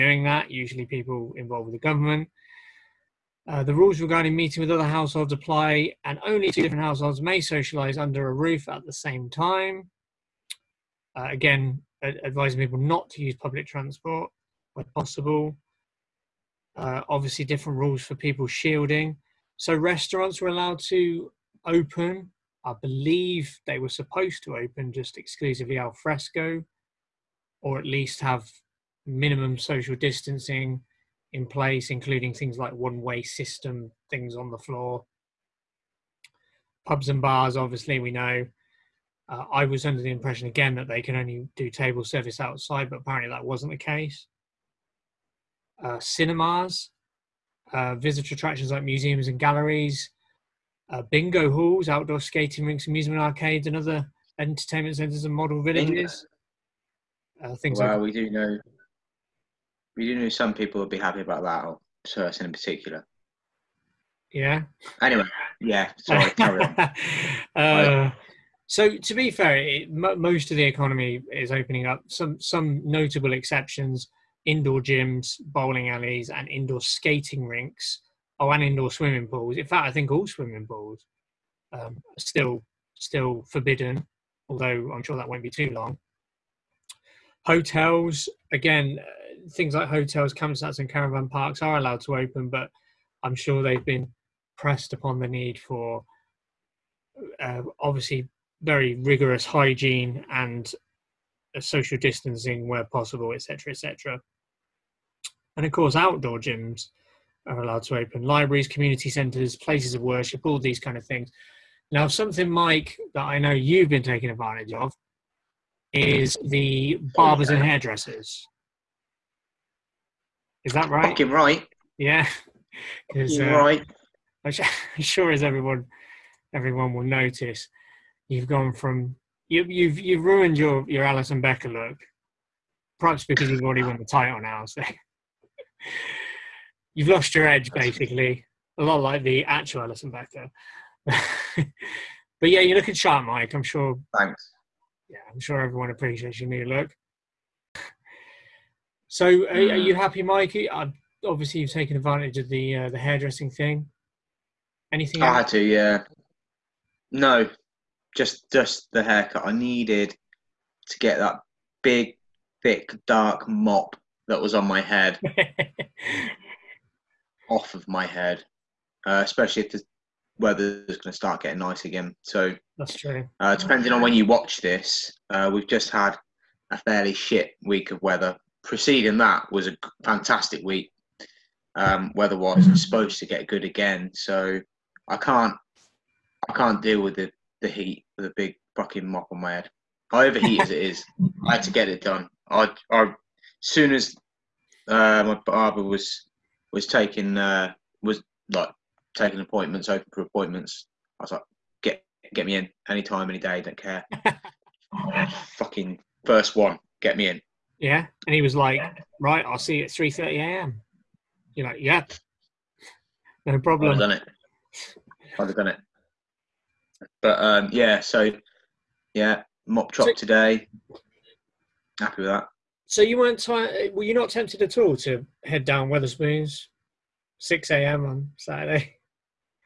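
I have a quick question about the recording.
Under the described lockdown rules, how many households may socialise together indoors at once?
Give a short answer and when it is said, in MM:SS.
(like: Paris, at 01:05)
2, at 00:06.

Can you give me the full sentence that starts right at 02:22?
but yeah, you're looking sharp, Mike.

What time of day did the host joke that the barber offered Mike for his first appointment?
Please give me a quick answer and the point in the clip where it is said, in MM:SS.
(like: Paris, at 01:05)
3:30 a.m., at 03:29.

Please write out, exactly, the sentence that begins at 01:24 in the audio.
Although I'm sure that won't be too long.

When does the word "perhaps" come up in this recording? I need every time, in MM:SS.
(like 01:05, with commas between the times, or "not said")
02:12.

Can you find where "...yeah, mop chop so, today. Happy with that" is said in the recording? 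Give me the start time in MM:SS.
03:39.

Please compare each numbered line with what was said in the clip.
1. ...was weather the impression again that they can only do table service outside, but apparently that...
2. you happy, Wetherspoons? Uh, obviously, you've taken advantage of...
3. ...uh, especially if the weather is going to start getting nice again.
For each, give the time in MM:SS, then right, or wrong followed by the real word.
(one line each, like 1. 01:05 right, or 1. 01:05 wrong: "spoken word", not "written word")
1. 00:39 wrong: "under", not "weather"
2. 02:29 wrong: "Mikey", not "Wetherspoons"
3. 02:49 right.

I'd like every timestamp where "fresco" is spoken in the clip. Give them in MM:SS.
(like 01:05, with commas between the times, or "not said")
00:25.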